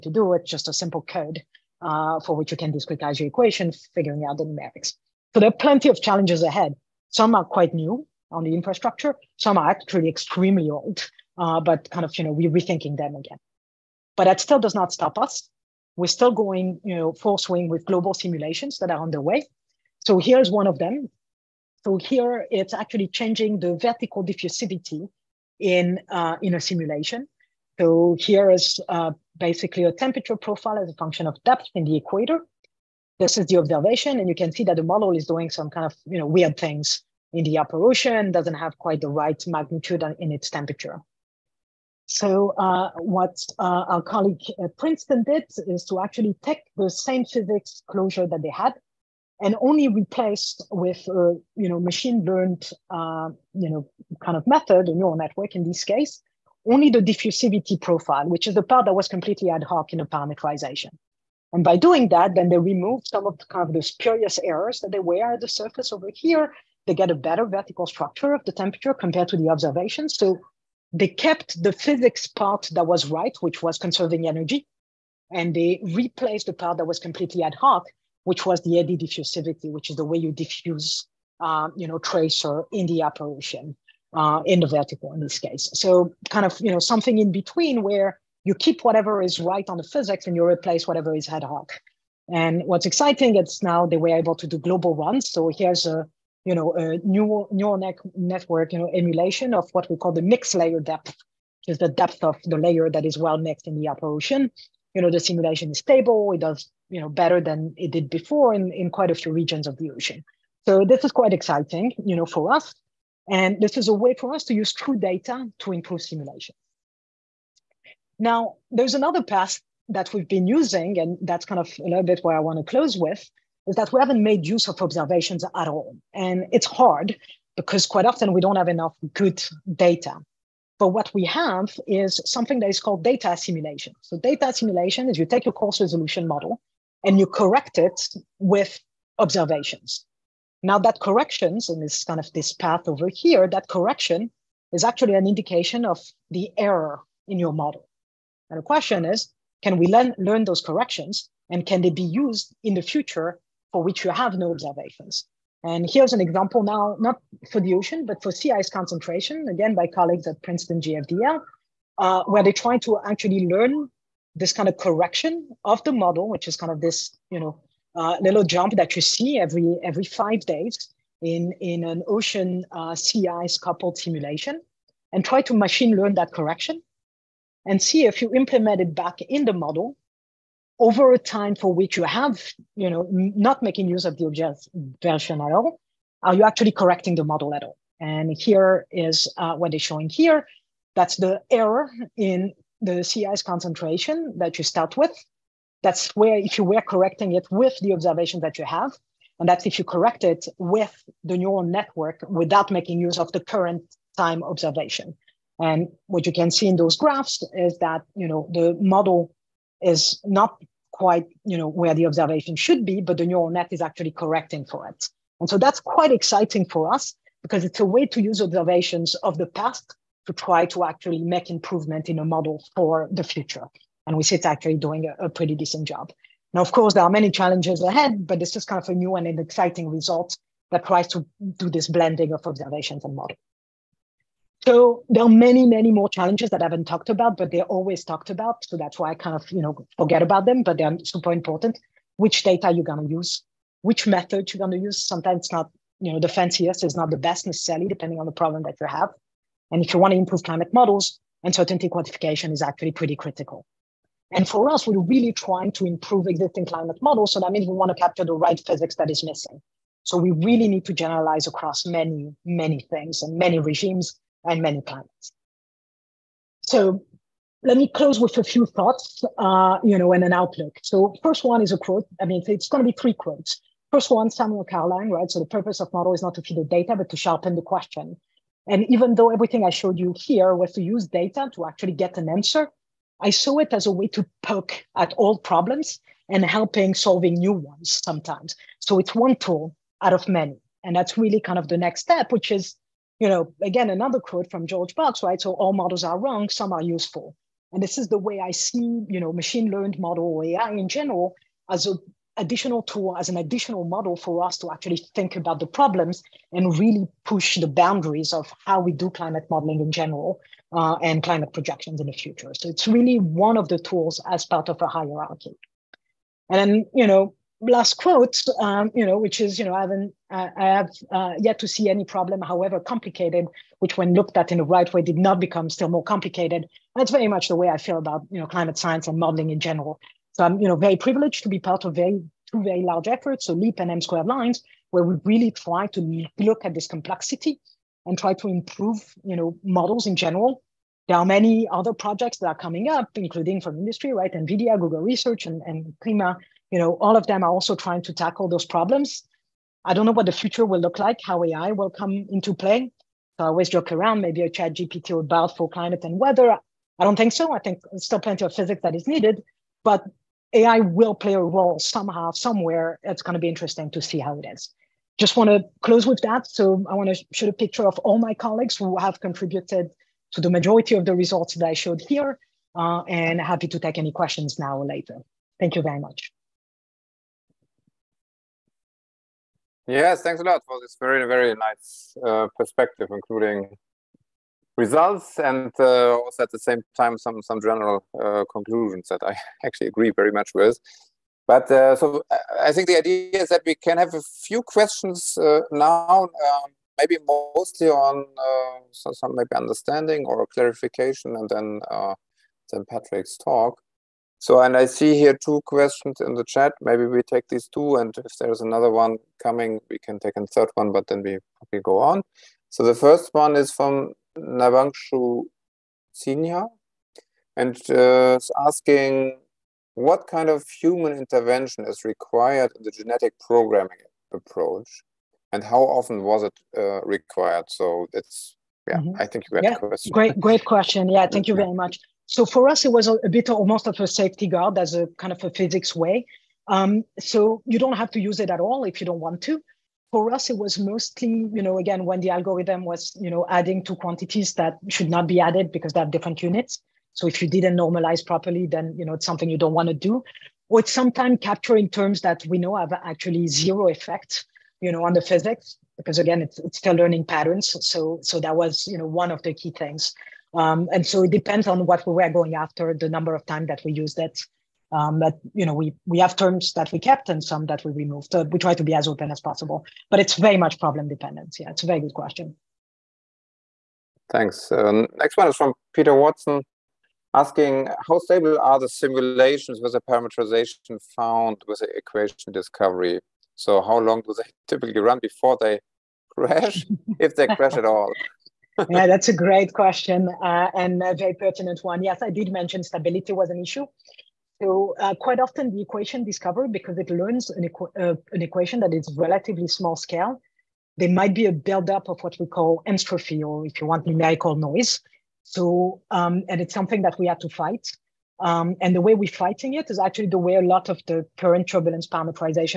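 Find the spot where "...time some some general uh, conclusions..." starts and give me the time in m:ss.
6:26.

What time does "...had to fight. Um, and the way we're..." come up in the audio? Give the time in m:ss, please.
8:27.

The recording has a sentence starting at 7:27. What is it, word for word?
So if you didn't normalize properly, then, you know, it's something you don't want to do.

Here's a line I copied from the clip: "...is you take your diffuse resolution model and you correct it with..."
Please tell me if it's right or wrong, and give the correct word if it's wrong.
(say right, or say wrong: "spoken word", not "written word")
wrong: "coarse", not "diffuse".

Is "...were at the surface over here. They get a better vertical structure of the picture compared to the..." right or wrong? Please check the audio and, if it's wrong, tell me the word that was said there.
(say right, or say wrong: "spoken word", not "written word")
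wrong: "temperature", not "picture".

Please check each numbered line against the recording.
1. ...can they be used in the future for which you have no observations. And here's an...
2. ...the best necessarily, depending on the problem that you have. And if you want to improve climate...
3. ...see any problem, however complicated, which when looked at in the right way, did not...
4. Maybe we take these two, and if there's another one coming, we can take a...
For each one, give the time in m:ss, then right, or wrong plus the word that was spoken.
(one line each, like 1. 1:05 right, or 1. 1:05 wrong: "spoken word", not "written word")
1. 2:31 right
2. 4:07 right
3. 5:21 right
4. 6:46 right.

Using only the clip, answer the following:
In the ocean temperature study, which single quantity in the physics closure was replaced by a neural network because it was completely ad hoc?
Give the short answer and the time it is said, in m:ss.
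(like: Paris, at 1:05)
diffusivity profile, at 0:56.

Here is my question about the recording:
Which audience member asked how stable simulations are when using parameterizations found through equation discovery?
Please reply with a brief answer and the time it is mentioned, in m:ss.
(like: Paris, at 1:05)
Peter Watson, at 7:55.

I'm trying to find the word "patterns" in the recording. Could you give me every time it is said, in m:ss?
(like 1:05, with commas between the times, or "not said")
7:37.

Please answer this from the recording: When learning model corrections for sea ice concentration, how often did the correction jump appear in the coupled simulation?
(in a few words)
every five days.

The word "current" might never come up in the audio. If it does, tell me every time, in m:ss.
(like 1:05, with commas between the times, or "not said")
3:23, 8:31.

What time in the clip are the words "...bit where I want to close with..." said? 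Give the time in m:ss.
2:02.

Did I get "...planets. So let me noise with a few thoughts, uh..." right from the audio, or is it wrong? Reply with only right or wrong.
wrong.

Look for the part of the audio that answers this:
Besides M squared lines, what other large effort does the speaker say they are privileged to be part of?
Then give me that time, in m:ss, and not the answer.
5:33.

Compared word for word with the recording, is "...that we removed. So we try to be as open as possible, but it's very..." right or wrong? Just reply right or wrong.
right.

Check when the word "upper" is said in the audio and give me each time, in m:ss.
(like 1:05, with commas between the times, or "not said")
0:37, 1:43.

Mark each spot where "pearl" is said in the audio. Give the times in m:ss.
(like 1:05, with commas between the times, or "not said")
not said.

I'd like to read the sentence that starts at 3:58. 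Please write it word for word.
So that's why I kind of, you know, forget about them, but they're super important.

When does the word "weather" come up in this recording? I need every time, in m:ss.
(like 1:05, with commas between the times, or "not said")
5:56.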